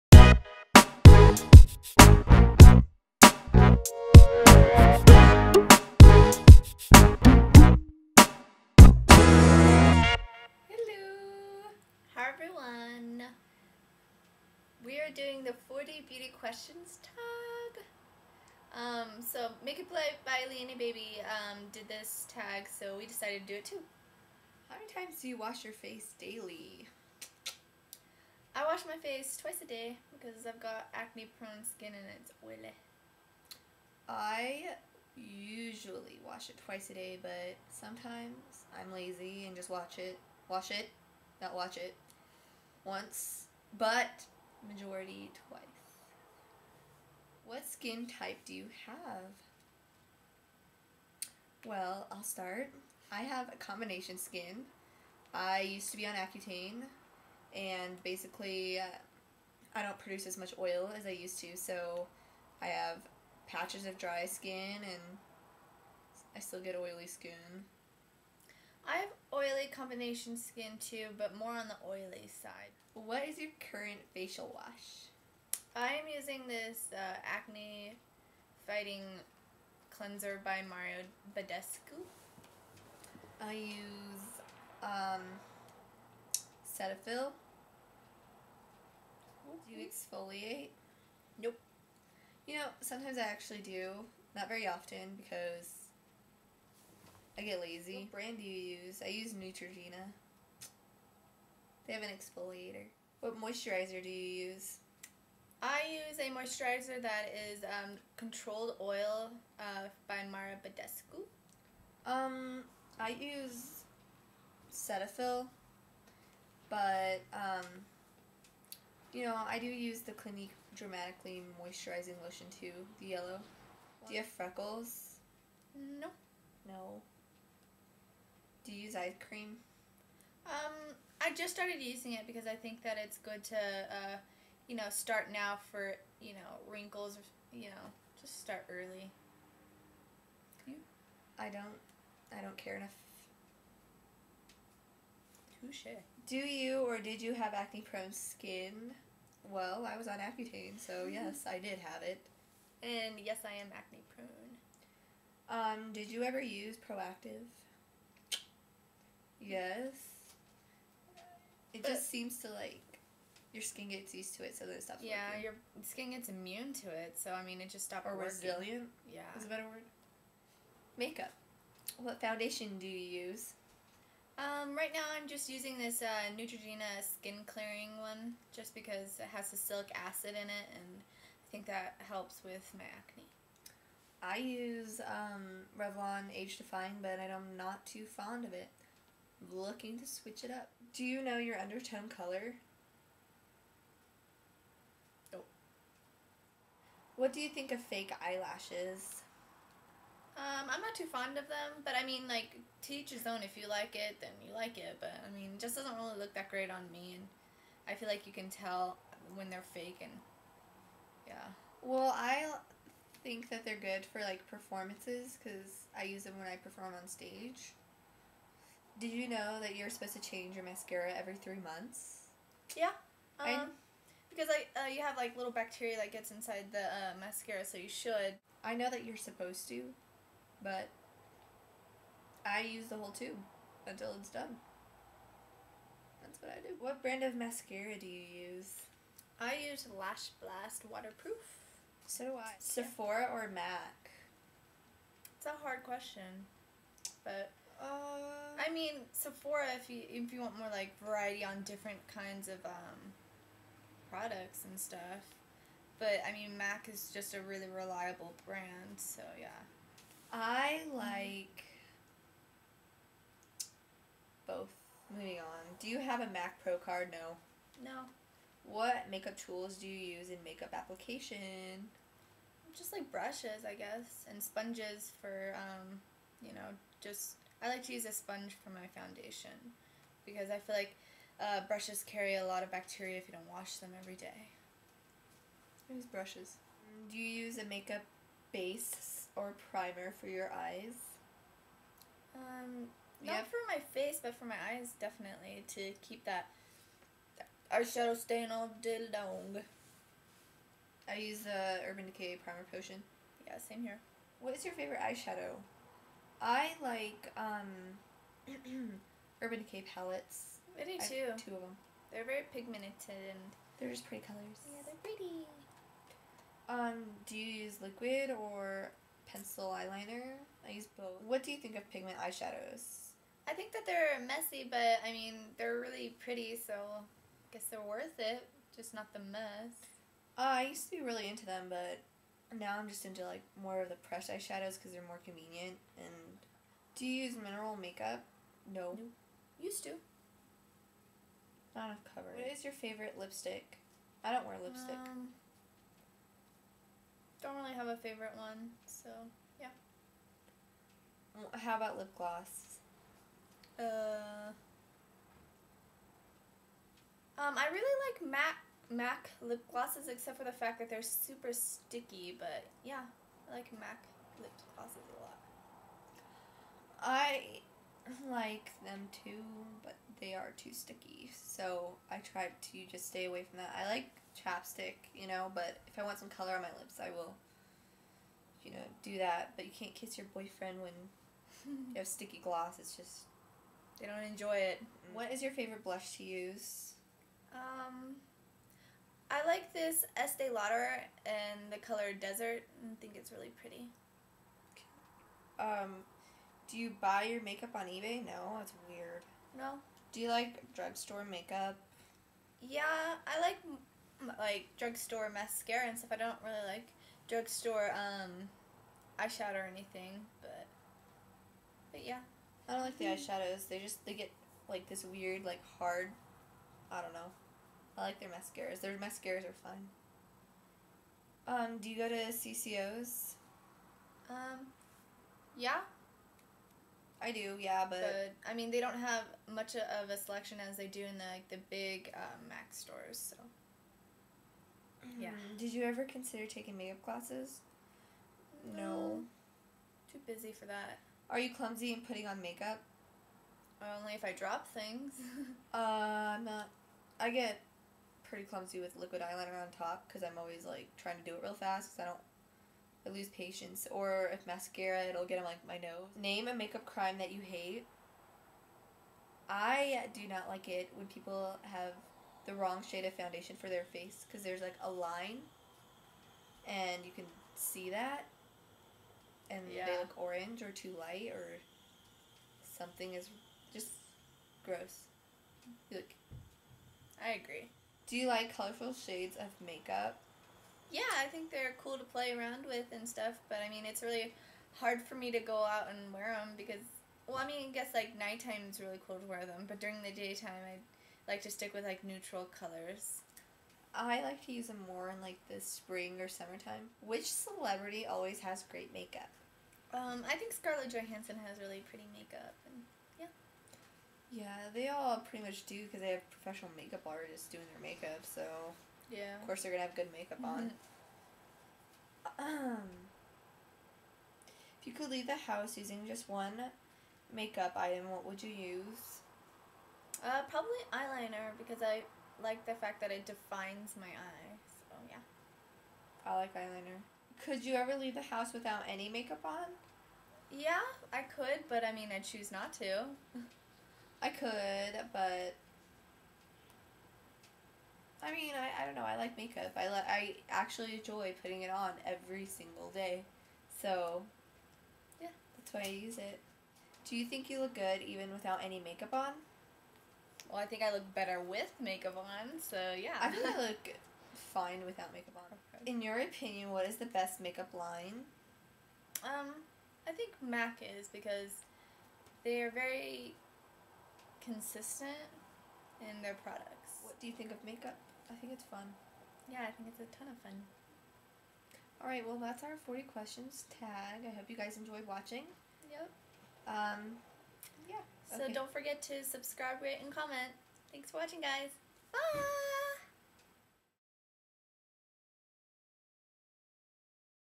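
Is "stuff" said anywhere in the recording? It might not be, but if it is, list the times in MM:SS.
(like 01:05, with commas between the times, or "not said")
04:14, 06:45, 08:03.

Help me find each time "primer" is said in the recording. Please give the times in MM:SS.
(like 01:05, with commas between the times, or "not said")
04:49, 05:02.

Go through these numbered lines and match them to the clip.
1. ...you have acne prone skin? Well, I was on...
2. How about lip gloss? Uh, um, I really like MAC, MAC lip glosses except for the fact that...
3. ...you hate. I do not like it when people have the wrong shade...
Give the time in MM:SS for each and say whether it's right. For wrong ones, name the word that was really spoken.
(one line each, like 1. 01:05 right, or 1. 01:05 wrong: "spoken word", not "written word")
1. 02:27 right
2. 05:51 right
3. 07:37 right.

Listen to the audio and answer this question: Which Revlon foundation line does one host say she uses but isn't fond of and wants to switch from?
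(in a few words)
Age Define.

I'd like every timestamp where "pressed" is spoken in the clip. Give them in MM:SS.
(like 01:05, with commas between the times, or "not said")
05:33.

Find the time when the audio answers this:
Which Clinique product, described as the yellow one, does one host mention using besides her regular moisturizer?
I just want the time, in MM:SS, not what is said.
02:00.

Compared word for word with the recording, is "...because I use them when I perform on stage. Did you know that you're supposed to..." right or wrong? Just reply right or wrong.
right.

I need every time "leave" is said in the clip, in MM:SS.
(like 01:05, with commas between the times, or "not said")
08:35, 08:47.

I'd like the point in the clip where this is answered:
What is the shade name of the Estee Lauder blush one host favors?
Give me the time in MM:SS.
06:32.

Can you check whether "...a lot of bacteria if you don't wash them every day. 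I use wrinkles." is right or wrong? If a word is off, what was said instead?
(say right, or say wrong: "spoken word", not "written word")
wrong: "brushes", not "wrinkles".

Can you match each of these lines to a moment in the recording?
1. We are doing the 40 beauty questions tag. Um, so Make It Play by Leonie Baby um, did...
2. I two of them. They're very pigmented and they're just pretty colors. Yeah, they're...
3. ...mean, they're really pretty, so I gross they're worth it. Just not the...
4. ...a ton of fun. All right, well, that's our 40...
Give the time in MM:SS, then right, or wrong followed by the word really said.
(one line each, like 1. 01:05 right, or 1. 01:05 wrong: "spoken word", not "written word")
1. 00:14 right
2. 05:11 right
3. 05:25 wrong: "guess", not "gross"
4. 09:30 right.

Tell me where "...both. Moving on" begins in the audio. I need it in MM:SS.
04:24.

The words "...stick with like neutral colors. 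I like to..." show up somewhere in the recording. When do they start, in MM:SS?
08:11.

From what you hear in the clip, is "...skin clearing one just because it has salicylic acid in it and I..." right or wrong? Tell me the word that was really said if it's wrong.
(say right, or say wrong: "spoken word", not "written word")
right.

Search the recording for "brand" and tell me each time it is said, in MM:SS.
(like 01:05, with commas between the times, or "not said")
01:38, 03:57, 04:18.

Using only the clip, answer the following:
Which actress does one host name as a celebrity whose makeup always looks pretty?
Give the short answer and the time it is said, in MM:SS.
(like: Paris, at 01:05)
Scarlett Johansson, at 08:20.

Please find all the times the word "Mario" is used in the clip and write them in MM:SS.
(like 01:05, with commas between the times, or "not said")
01:20, 01:50.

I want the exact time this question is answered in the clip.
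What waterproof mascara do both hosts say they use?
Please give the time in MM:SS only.
03:59.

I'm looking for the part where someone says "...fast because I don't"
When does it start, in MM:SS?
07:31.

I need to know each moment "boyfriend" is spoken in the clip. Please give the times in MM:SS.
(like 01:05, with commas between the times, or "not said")
06:20.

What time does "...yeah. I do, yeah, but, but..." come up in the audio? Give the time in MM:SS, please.
07:05.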